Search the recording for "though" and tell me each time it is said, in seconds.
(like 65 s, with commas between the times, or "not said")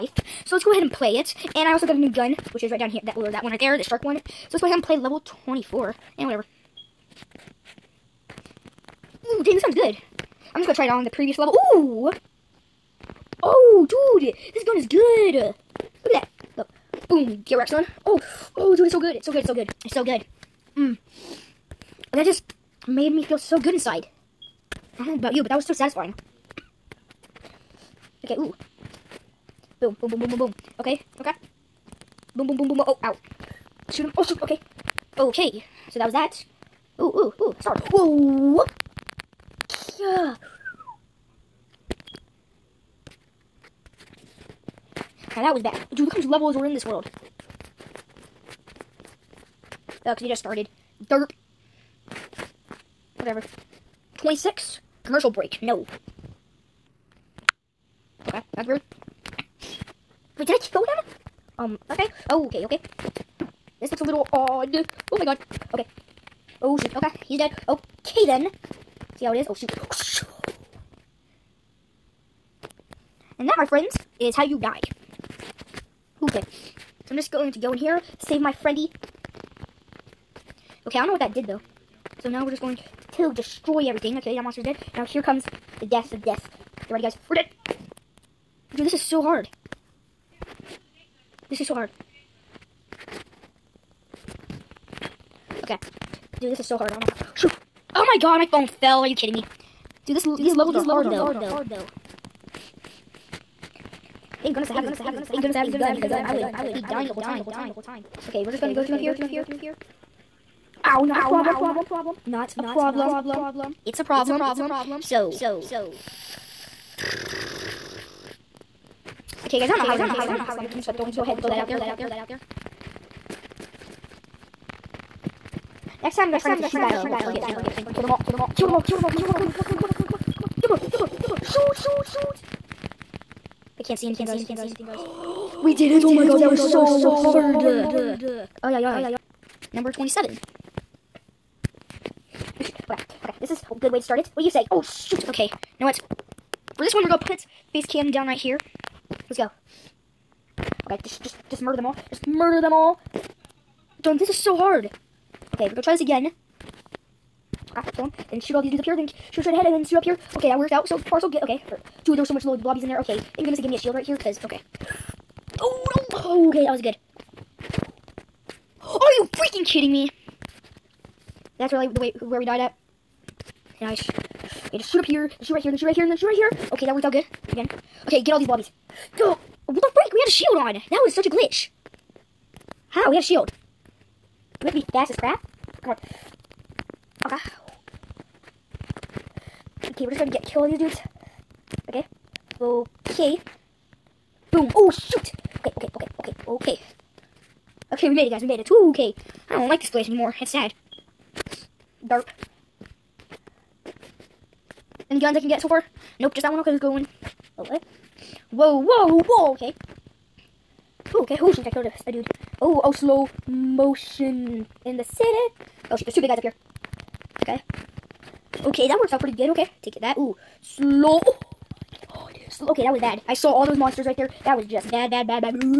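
81 s, 101 s.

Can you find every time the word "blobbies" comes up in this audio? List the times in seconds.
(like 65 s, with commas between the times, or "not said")
162 s, 178 s.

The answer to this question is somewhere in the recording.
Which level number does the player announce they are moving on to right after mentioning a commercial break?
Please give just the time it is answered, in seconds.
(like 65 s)
54 s.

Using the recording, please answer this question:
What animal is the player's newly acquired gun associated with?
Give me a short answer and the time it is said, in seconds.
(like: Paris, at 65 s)
Shark, at 3 s.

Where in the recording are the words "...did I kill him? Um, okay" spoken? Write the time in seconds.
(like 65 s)
60 s.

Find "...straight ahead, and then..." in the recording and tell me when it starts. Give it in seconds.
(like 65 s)
159 s.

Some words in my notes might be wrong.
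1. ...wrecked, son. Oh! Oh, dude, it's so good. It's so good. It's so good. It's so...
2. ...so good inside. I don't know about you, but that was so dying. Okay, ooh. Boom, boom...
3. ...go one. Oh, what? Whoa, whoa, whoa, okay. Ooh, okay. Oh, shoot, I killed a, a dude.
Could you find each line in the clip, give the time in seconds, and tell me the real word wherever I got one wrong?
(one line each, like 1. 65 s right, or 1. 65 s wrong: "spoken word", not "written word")
1. 17 s right
2. 23 s wrong: "satisfying", not "dying"
3. 206 s right.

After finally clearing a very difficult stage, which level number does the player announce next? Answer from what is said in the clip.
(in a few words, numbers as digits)
27.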